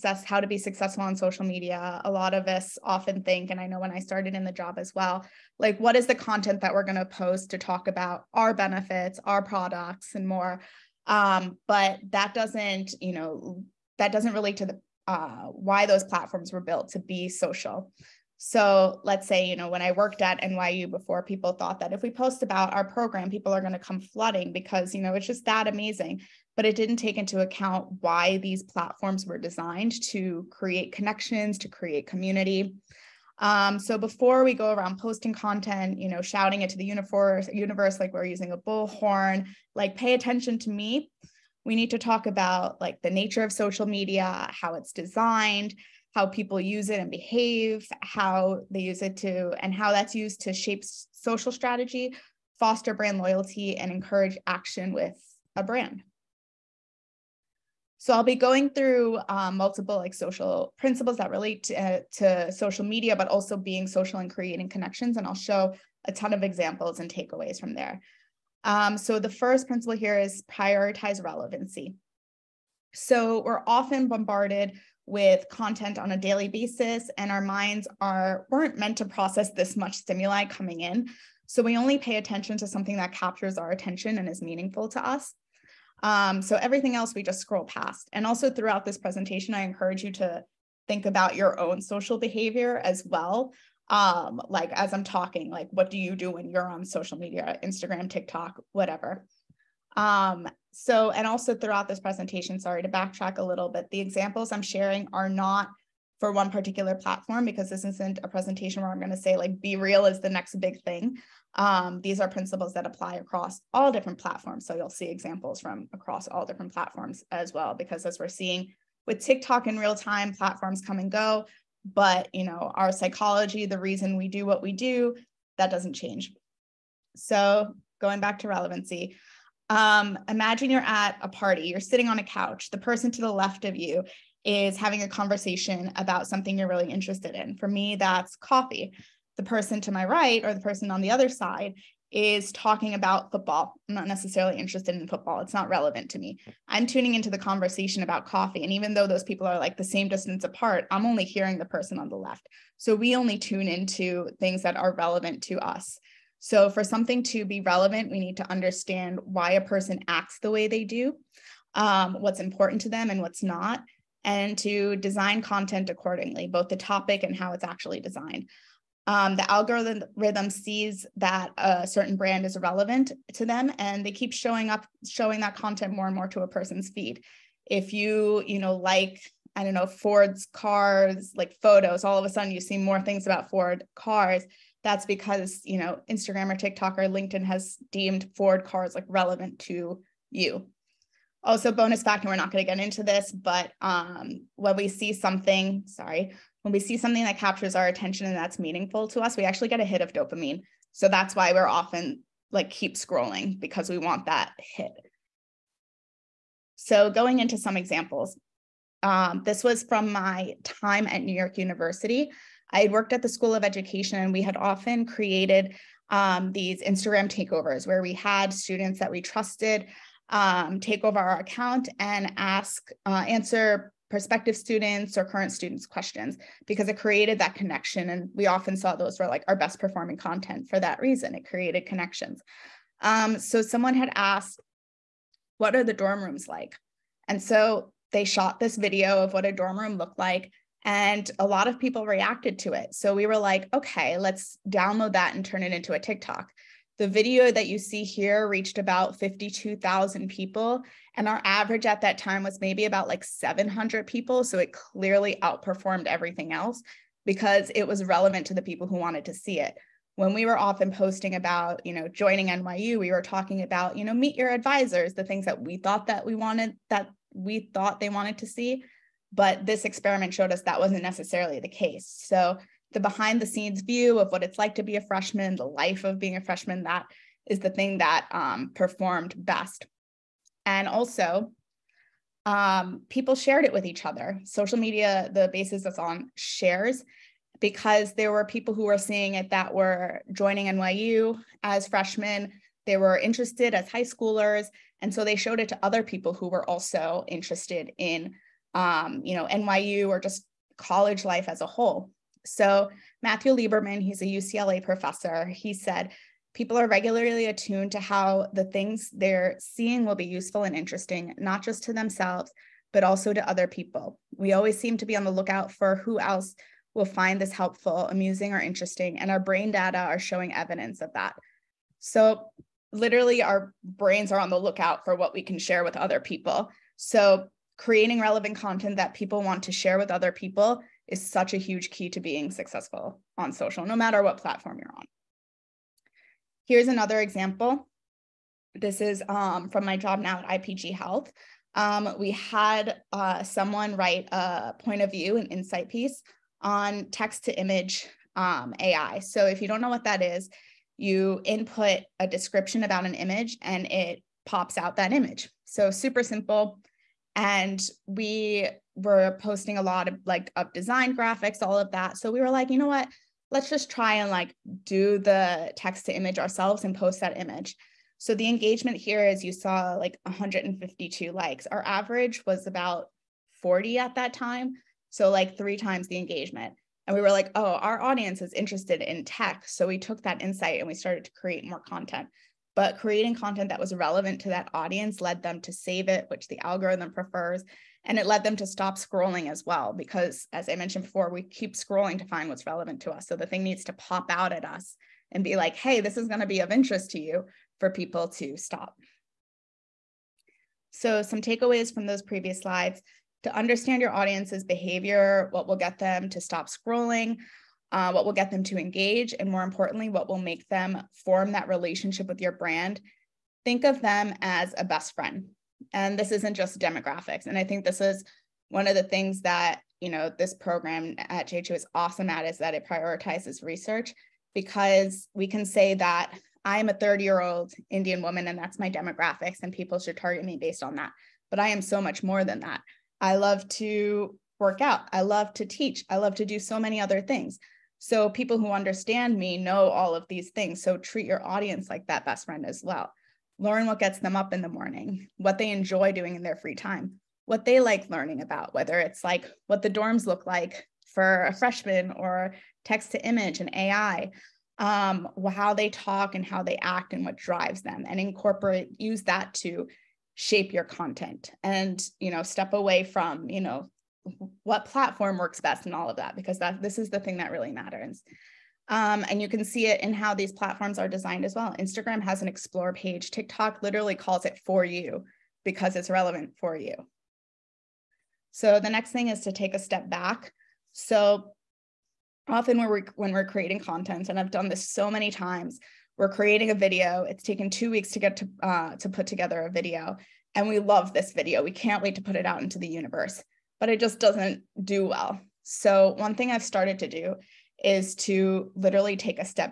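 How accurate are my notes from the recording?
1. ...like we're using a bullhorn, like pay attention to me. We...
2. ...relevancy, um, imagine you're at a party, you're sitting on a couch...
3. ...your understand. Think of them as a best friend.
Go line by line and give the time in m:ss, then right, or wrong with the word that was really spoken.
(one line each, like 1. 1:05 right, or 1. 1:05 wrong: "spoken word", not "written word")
1. 0:37 right
2. 2:08 right
3. 6:52 wrong: "brand", not "understand".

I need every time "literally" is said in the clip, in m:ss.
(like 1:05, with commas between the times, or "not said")
5:22, 7:53, 8:18.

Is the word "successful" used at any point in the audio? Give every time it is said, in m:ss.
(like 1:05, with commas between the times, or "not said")
0:00, 5:32.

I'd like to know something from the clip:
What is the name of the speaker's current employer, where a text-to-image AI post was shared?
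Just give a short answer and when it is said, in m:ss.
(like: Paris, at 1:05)
IPG Health, at 5:40.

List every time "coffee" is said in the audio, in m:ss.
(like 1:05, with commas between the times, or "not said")
2:18, 2:28.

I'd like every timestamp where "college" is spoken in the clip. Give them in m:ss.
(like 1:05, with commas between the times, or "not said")
5:00.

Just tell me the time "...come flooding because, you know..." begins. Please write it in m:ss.
0:23.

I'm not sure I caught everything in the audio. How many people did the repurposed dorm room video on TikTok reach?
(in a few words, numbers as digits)
52,000.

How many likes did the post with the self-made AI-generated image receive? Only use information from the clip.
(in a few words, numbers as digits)
152.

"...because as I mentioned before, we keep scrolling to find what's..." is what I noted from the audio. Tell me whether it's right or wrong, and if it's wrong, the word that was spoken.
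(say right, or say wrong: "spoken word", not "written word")
right.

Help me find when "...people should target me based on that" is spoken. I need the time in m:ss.
7:09.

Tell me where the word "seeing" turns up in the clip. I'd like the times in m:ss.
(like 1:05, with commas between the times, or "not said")
1:58, 4:48, 5:09.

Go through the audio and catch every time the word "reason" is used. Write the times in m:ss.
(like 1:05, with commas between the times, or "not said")
2:03, 3:51.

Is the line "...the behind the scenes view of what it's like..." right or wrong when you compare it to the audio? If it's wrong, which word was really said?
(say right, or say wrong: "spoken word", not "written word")
right.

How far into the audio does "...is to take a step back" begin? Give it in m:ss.
7:59.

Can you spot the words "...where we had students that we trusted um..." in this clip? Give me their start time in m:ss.
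3:37.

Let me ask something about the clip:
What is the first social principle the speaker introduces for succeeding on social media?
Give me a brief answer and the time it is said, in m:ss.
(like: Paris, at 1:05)
prioritize relevancy, at 1:10.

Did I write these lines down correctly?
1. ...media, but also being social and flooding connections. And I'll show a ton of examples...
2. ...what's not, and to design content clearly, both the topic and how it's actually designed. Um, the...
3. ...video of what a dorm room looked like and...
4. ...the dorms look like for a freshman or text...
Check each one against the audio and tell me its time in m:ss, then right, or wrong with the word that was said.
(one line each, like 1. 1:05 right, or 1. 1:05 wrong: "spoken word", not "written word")
1. 1:02 wrong: "creating", not "flooding"
2. 2:43 wrong: "accordingly", not "clearly"
3. 3:58 right
4. 7:29 right.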